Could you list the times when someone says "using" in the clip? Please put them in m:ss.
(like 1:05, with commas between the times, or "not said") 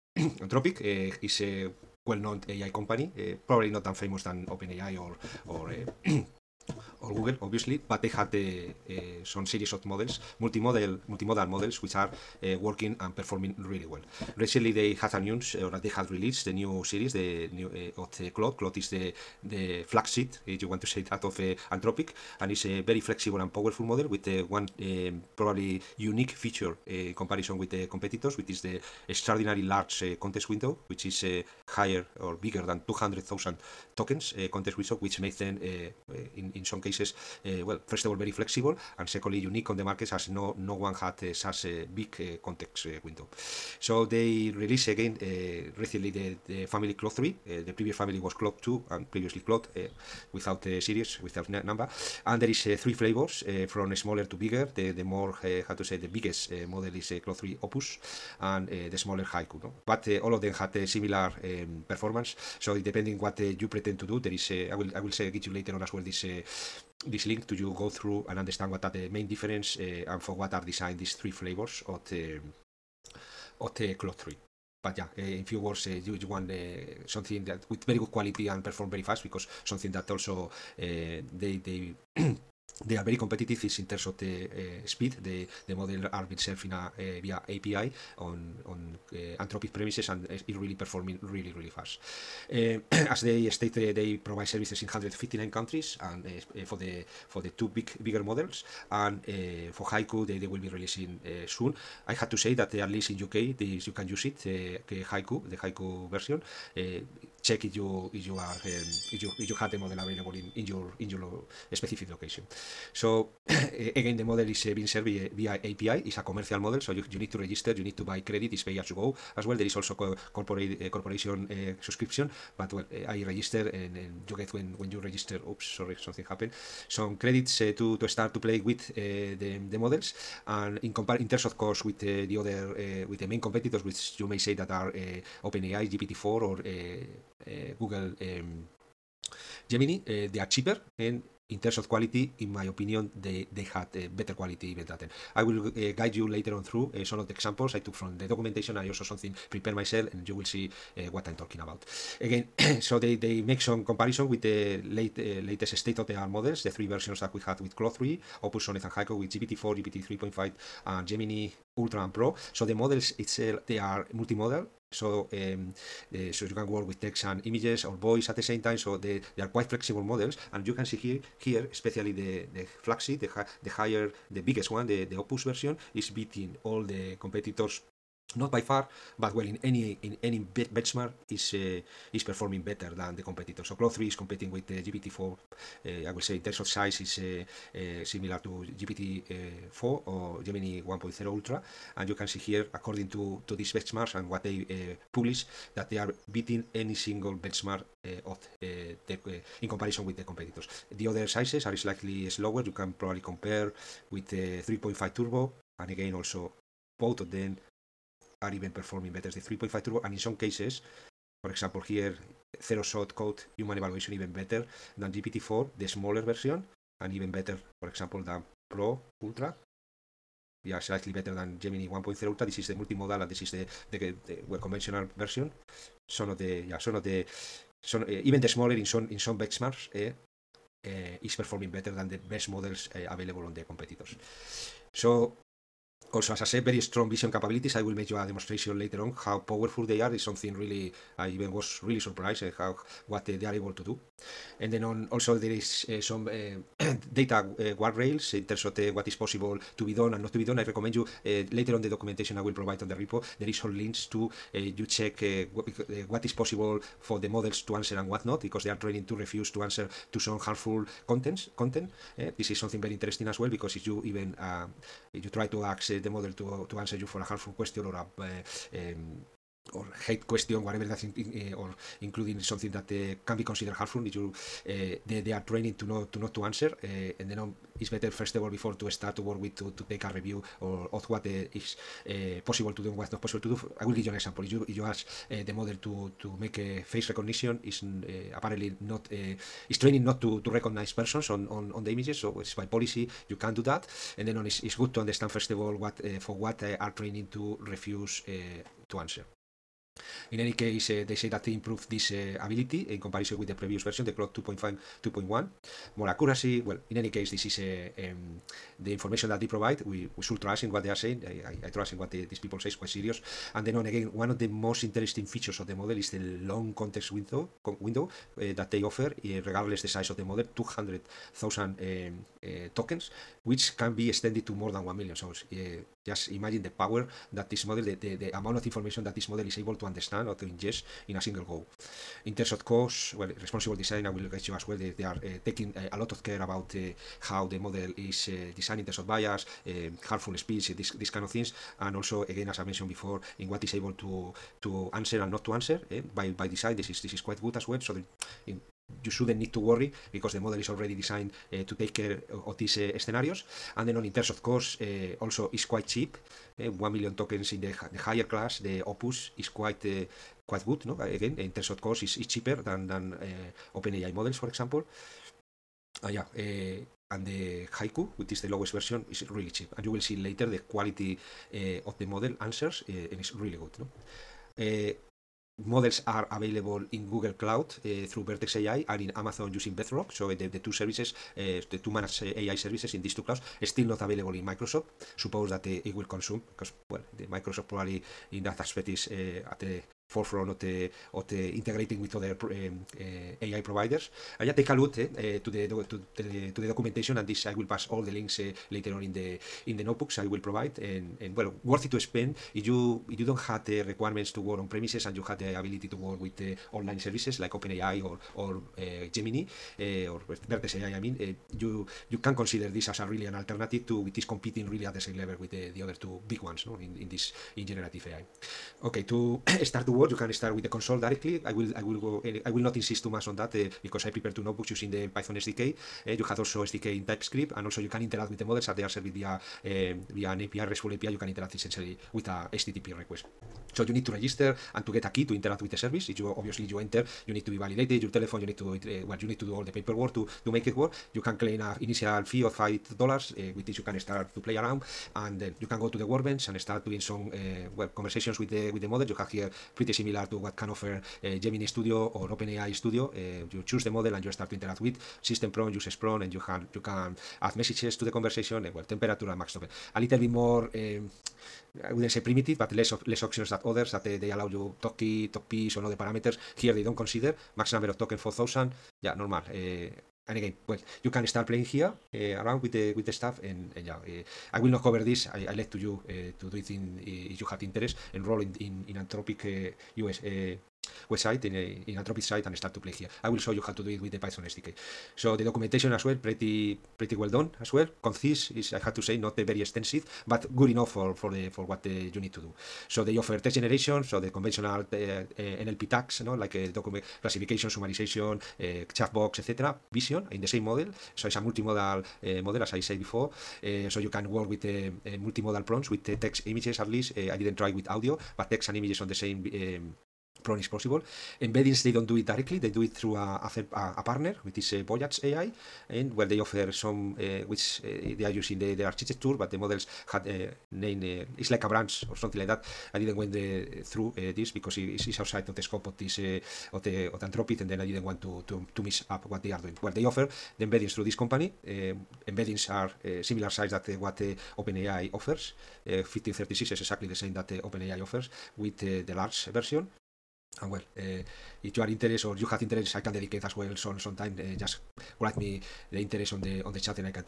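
6:19, 7:04, 8:38.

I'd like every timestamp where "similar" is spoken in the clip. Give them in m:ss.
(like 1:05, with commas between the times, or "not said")
1:00, 3:08, 7:29, 8:53.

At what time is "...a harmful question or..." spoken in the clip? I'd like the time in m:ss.
4:27.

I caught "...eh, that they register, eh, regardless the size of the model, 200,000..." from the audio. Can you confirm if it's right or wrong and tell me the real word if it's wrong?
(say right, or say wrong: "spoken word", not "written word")
wrong: "offer", not "register".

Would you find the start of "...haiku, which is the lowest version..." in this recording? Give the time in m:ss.
6:07.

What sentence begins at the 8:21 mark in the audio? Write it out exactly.
So it's a multimodal eh, model, as I said before.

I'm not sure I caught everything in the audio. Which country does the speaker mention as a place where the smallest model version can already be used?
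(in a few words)
UK.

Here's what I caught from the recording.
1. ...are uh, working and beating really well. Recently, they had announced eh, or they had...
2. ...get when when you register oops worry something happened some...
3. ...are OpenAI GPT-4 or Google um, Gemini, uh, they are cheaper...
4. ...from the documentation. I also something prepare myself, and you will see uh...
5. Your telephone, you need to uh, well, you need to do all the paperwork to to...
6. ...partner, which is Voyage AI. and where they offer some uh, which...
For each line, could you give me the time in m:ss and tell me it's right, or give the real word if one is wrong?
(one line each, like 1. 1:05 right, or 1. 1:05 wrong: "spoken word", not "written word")
1. 0:11 wrong: "performing", not "beating"
2. 2:04 wrong: "sorry", not "worry"
3. 2:14 right
4. 2:27 right
5. 7:18 right
6. 8:34 right.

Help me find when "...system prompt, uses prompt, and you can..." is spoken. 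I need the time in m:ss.
7:35.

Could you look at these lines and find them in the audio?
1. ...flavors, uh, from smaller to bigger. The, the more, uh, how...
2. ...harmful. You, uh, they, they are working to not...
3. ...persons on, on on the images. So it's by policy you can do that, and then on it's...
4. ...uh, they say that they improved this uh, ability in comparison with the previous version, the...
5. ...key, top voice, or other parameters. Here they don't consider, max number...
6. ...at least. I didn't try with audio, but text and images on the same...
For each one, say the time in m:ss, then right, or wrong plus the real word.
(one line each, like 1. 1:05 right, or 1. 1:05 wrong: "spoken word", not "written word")
1. 0:52 right
2. 4:33 wrong: "training", not "working"
3. 4:50 right
4. 5:00 right
5. 7:44 wrong: "piece", not "voice"
6. 8:26 right.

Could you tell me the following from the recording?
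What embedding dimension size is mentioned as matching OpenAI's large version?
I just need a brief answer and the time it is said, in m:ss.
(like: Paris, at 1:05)
1536, at 8:55.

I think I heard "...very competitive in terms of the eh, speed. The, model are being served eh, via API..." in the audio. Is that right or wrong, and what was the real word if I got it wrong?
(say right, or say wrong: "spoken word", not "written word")
right.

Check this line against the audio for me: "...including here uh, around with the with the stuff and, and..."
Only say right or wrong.
wrong.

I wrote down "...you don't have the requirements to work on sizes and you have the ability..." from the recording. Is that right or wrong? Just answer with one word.
wrong.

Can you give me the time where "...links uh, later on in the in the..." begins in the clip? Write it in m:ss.
6:38.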